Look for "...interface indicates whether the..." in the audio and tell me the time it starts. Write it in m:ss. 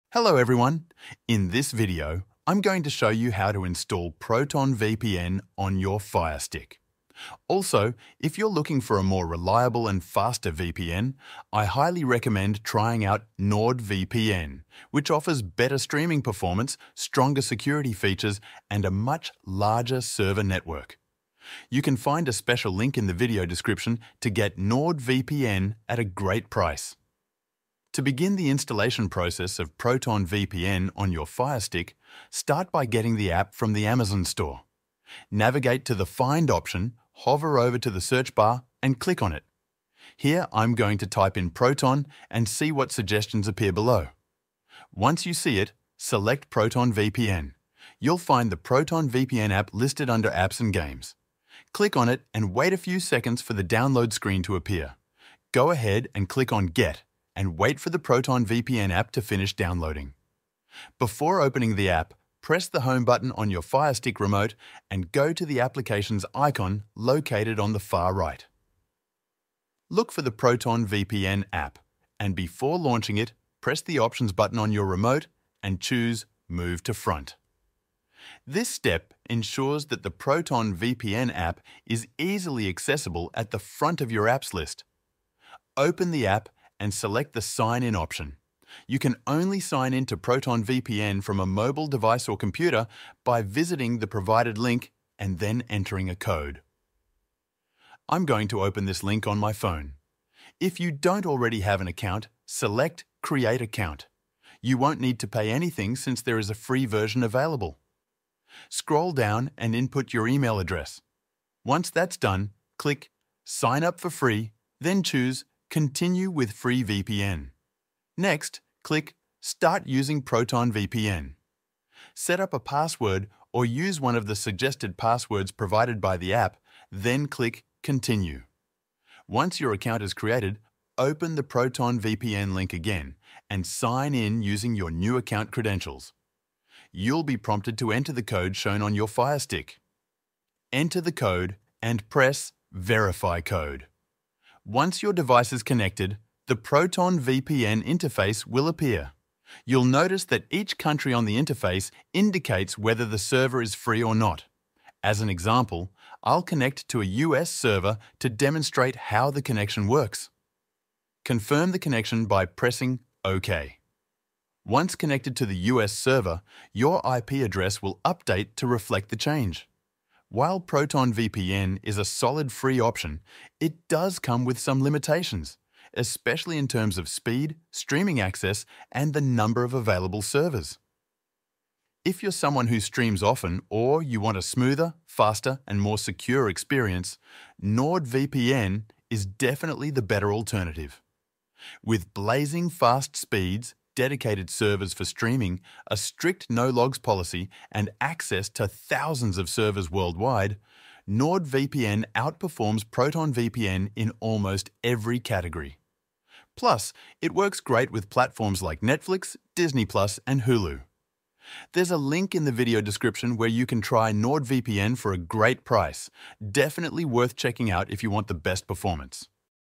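2:31.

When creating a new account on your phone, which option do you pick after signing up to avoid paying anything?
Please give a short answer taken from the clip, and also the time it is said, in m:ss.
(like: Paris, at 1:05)
Continue with Free VPN, at 1:55.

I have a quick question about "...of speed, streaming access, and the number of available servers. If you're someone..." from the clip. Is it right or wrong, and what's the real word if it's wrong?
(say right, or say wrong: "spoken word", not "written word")
right.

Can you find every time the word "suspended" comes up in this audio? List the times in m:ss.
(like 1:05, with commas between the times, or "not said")
not said.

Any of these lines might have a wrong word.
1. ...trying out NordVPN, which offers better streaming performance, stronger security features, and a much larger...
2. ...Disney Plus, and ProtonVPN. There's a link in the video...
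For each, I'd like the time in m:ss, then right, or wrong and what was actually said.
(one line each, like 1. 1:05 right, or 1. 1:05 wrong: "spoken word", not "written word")
1. 0:12 right
2. 3:29 wrong: "Hulu", not "ProtonVPN".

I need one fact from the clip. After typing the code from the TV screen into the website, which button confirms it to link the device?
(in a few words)
Verify Code.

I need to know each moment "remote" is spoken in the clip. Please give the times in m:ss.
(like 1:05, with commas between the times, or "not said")
1:04, 1:14.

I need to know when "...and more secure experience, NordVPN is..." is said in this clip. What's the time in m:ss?
3:05.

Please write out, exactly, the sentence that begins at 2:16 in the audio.
You'll be prompted to enter the code shown on your Fire Stick.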